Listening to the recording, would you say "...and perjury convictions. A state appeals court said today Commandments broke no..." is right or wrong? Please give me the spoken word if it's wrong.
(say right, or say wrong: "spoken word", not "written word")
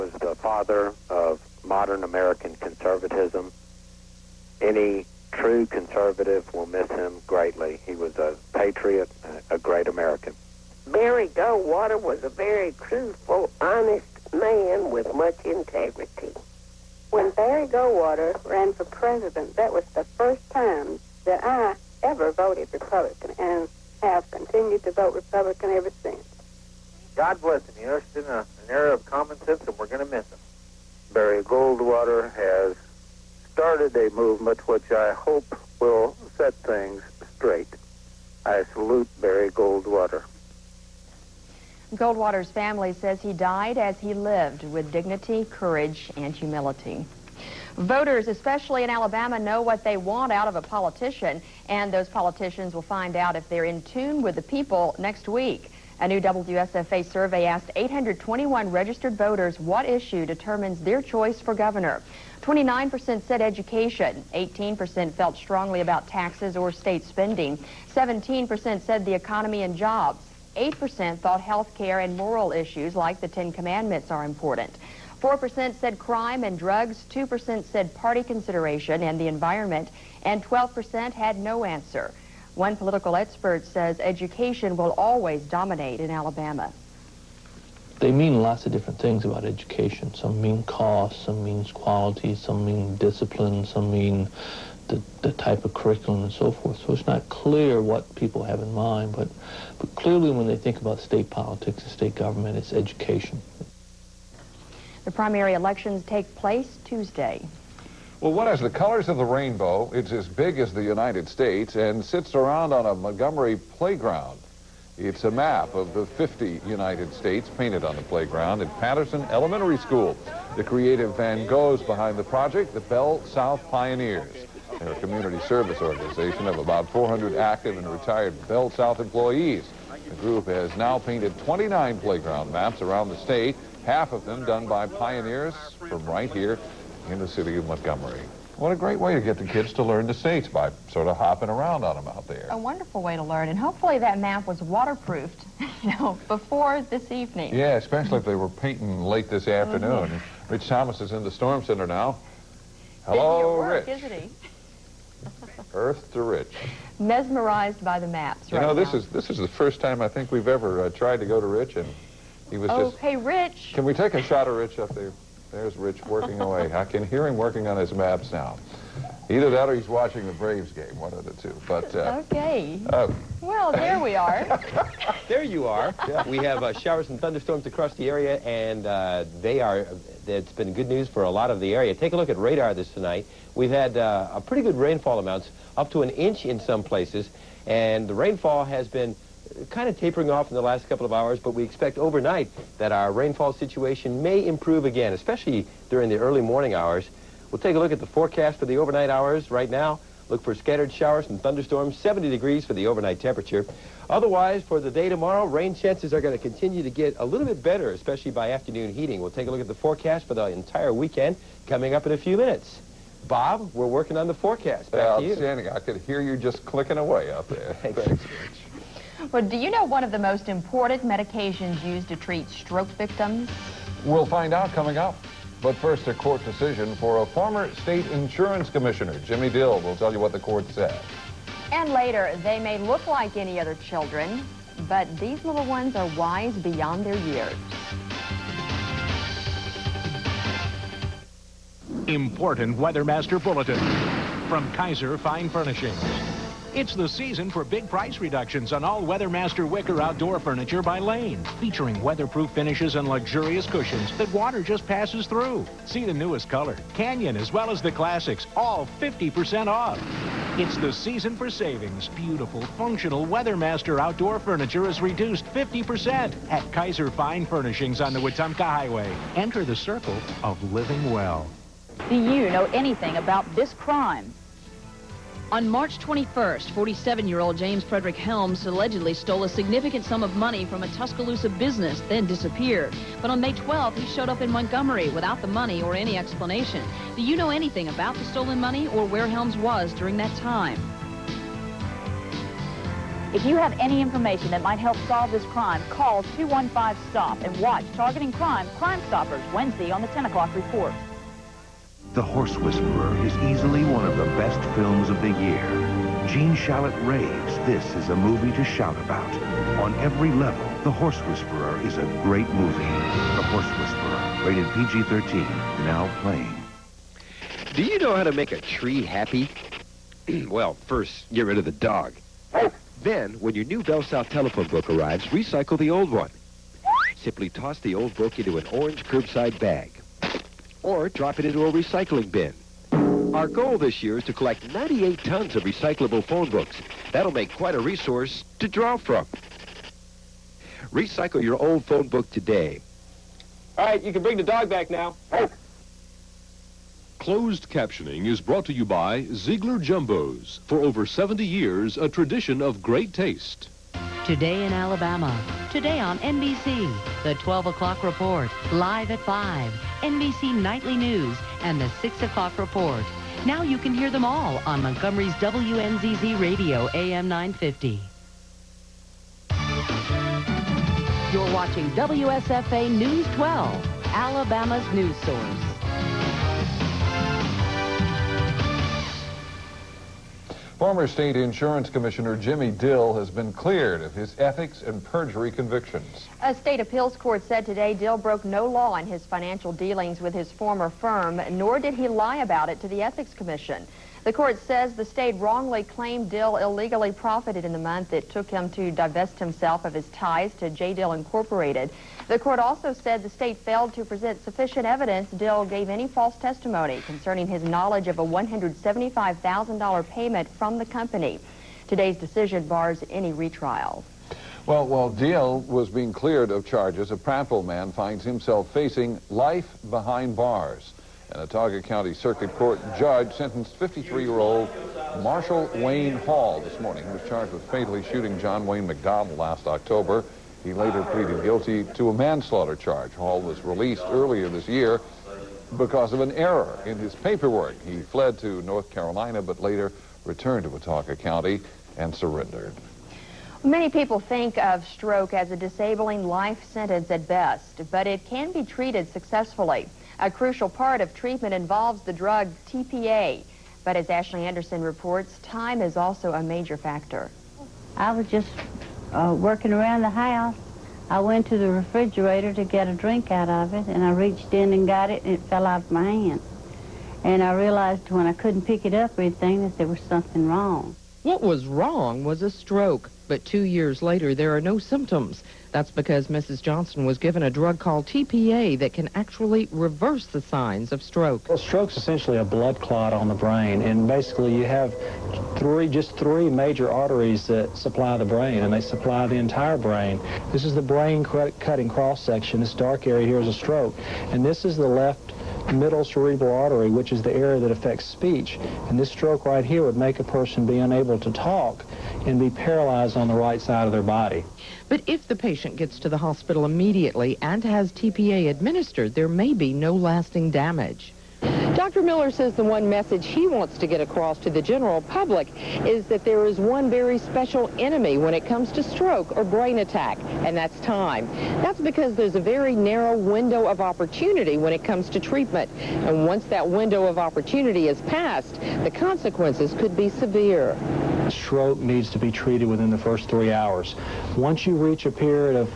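wrong: "Dill", not "Commandments".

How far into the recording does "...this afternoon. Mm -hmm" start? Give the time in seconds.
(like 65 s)
149 s.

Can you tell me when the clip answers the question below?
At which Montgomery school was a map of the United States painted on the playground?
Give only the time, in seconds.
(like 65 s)
118 s.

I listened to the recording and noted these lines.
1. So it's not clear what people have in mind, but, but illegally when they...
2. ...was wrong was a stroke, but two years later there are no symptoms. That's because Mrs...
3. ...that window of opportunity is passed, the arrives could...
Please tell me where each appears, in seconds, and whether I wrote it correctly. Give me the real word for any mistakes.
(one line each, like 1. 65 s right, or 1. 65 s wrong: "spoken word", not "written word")
1. 96 s wrong: "clearly", not "illegally"
2. 471 s right
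3. 526 s wrong: "consequences", not "arrives".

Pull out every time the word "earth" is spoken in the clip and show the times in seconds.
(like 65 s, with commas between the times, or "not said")
155 s.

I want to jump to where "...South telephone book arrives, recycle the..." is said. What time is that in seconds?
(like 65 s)
324 s.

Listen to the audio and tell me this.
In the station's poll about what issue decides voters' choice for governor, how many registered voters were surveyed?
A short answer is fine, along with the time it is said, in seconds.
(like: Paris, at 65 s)
821, at 57 s.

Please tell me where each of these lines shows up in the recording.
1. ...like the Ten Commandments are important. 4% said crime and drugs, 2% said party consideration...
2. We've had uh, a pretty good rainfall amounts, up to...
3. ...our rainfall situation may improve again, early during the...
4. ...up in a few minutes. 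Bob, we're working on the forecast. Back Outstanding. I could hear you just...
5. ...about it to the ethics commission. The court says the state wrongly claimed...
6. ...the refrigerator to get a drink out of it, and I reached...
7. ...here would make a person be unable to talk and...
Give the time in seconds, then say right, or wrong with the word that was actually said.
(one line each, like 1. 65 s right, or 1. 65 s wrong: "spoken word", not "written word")
1. 72 s right
2. 183 s right
3. 192 s wrong: "especially", not "early"
4. 211 s right
5. 392 s right
6. 461 s right
7. 499 s right.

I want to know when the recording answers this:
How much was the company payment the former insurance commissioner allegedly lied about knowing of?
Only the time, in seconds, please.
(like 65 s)
408 s.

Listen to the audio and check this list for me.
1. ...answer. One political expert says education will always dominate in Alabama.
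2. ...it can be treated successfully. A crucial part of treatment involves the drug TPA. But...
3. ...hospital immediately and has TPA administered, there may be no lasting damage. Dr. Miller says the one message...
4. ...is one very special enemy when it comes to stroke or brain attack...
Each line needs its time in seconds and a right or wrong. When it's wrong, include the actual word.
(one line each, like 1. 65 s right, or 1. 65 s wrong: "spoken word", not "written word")
1. 81 s right
2. 448 s right
3. 506 s right
4. 516 s right.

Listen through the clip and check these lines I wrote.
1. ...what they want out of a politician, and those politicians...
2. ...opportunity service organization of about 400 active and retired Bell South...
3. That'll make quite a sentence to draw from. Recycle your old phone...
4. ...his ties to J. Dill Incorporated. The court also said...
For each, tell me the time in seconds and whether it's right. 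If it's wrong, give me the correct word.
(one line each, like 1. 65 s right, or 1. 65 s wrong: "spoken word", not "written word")
1. 49 s right
2. 125 s wrong: "community", not "opportunity"
3. 337 s wrong: "resource", not "sentence"
4. 399 s right.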